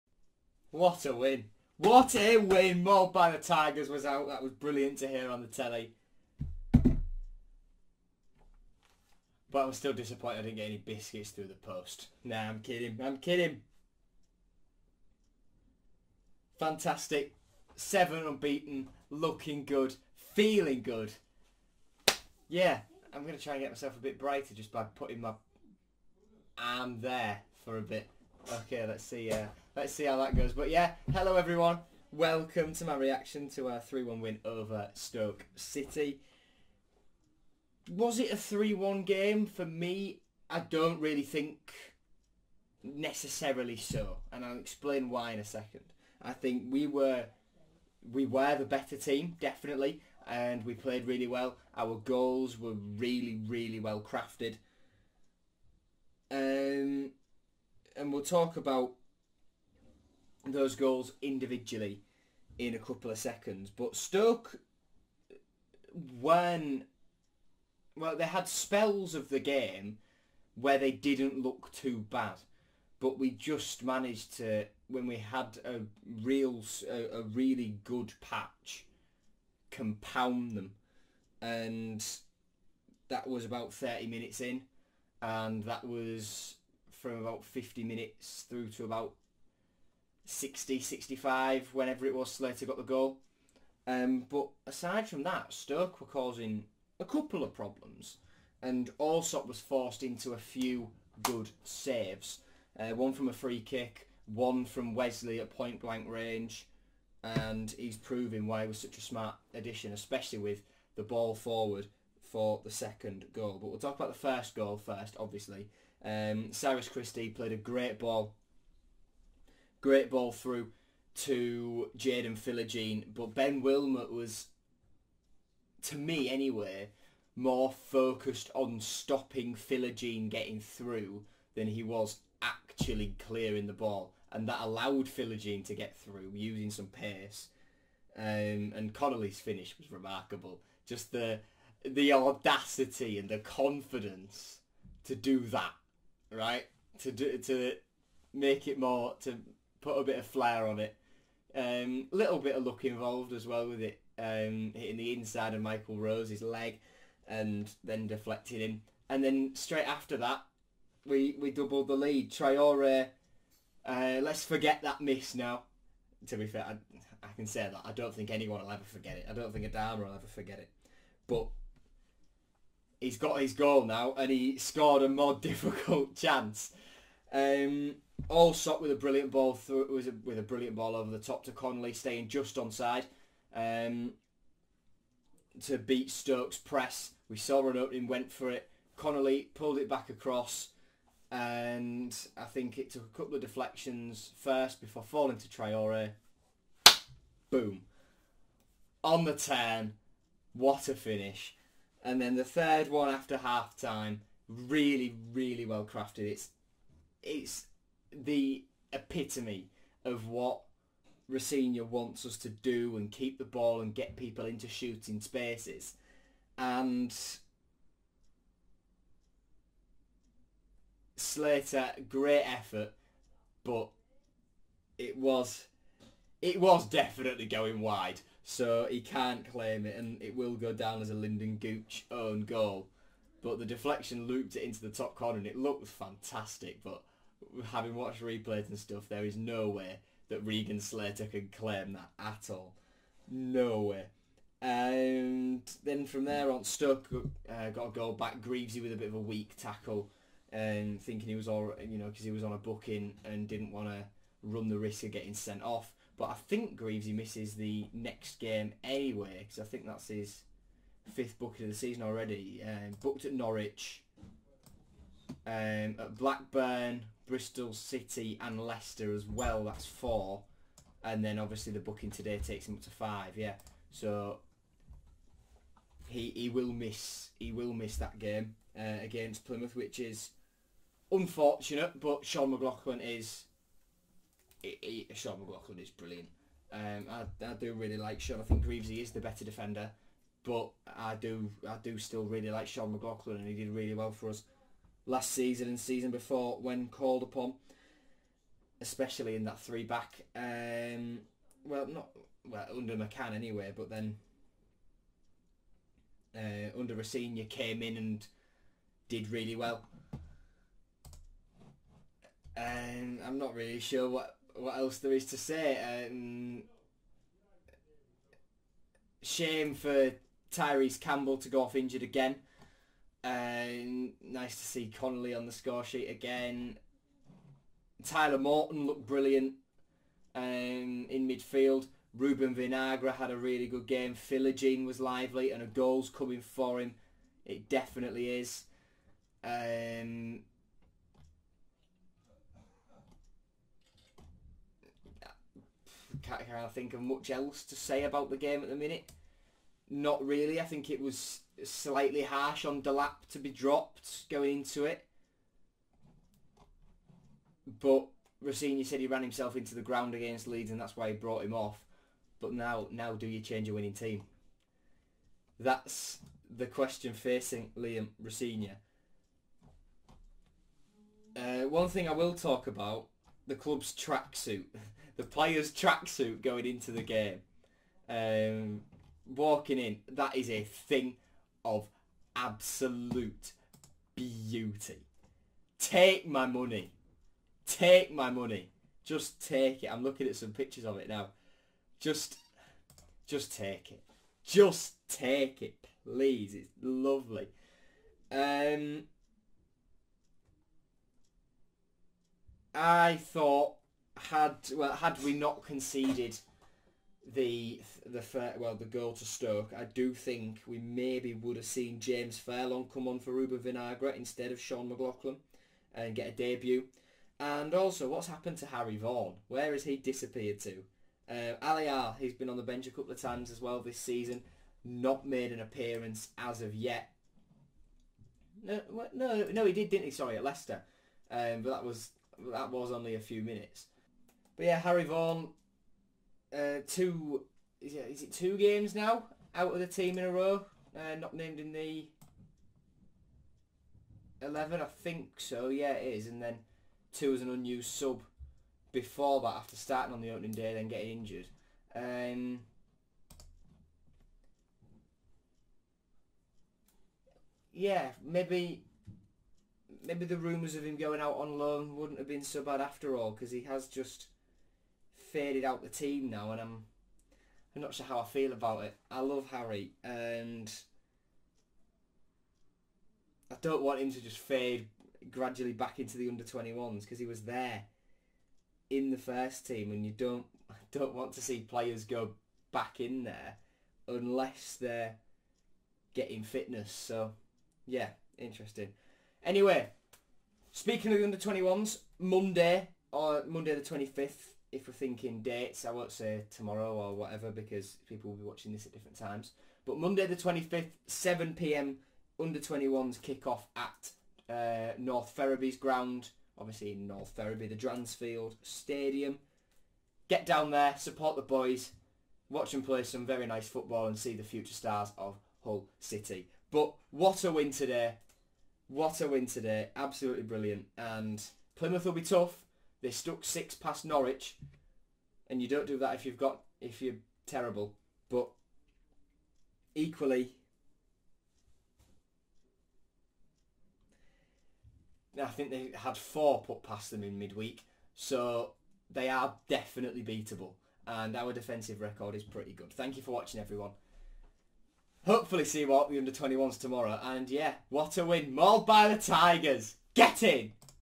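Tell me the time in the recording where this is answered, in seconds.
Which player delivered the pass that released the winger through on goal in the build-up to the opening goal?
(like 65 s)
116 s.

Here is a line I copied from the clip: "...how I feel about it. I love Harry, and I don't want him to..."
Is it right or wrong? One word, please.
right.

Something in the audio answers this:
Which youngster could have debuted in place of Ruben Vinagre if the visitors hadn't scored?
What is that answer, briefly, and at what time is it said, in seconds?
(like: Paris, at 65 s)
James Furlong, at 411 s.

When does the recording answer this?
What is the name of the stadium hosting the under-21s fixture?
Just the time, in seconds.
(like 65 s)
507 s.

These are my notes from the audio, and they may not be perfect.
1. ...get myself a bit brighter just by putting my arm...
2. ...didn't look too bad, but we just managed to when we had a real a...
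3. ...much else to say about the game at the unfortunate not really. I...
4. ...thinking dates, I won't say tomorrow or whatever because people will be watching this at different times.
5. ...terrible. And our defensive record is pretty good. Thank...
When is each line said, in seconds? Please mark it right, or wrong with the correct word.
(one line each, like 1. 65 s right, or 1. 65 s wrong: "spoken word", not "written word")
1. 23 s right
2. 70 s right
3. 347 s wrong: "minute", not "unfortunate"
4. 494 s right
5. 540 s wrong: "beatable", not "terrible".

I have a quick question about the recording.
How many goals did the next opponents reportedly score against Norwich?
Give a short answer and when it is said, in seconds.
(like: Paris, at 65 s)
6, at 523 s.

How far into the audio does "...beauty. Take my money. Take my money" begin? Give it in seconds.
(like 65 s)
384 s.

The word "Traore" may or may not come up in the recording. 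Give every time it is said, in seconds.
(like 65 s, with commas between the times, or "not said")
162 s, 195 s.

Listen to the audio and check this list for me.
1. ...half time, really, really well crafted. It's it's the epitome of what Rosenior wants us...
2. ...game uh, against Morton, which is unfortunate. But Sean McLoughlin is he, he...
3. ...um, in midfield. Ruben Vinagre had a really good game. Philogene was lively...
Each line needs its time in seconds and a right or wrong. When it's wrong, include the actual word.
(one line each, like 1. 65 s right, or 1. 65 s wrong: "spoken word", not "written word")
1. 203 s right
2. 278 s wrong: "Plymouth", not "Morton"
3. 330 s right.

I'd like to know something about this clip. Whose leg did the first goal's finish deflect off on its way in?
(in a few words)
Michael Rose.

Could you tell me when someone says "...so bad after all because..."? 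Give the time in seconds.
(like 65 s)
462 s.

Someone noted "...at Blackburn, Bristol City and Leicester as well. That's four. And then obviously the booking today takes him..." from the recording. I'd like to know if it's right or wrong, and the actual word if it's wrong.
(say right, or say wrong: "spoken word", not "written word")
right.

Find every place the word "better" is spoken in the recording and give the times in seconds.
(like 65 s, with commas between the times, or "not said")
48 s, 289 s.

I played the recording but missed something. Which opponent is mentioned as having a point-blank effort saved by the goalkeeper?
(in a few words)
Wesley.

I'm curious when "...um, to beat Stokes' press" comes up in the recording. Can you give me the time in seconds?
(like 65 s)
183 s.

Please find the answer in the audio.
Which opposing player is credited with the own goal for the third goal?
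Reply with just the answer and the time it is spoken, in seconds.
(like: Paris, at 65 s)
Lynden Gooch, at 231 s.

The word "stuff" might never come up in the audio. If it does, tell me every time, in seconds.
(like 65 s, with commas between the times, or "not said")
238 s.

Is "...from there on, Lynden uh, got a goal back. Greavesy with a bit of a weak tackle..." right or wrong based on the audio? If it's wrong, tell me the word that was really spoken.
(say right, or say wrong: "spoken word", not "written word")
wrong: "Stoke", not "Lynden".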